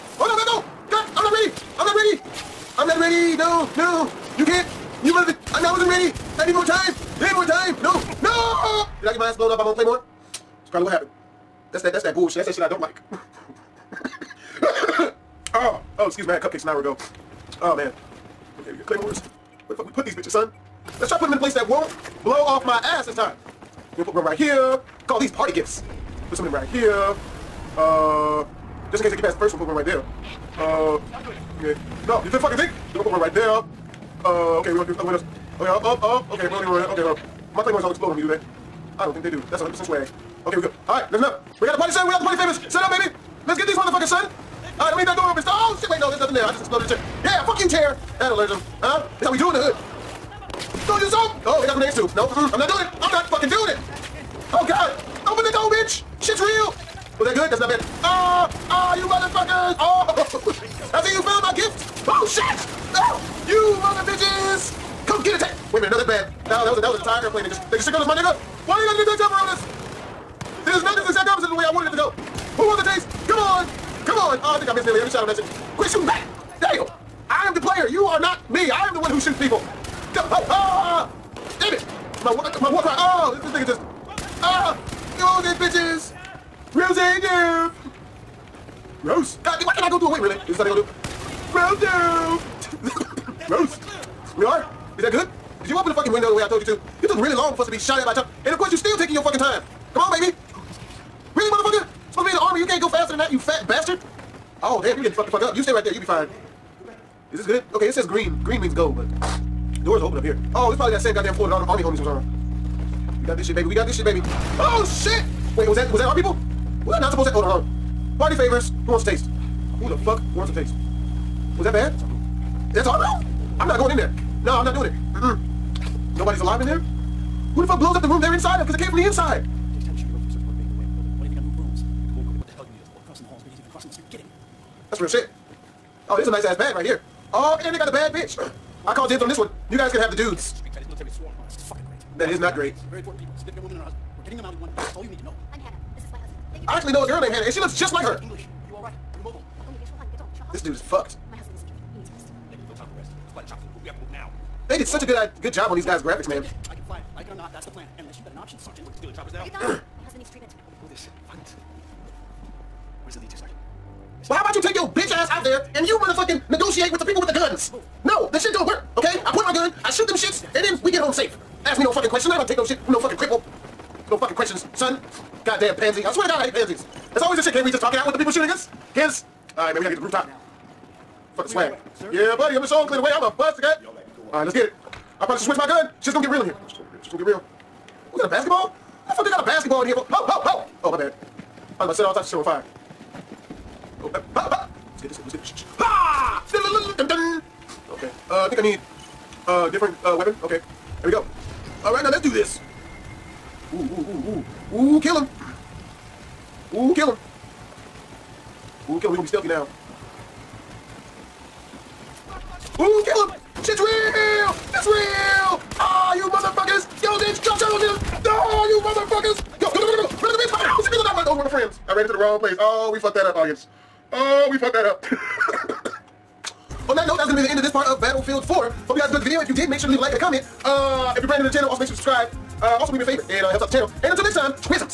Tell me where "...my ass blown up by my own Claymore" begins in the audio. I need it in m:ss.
0:09.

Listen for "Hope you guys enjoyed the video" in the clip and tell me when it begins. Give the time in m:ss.
3:48.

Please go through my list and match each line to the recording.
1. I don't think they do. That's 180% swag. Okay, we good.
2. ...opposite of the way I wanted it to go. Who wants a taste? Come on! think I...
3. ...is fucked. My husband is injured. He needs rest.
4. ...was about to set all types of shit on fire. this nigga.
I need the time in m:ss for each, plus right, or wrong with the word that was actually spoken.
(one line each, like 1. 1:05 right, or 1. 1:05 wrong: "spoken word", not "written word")
1. 0:38 wrong: "100", not "180"
2. 1:11 right
3. 2:30 right
4. 3:11 right.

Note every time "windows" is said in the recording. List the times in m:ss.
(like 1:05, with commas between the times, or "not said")
0:35, 1:36.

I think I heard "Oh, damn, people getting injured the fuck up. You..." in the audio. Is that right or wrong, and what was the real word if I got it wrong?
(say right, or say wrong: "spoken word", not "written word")
wrong: "fucked", not "injured".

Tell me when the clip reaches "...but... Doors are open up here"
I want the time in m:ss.
1:48.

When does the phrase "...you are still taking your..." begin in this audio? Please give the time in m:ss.
1:38.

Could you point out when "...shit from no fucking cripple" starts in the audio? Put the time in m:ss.
2:52.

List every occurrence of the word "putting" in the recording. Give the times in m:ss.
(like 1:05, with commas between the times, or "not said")
0:21.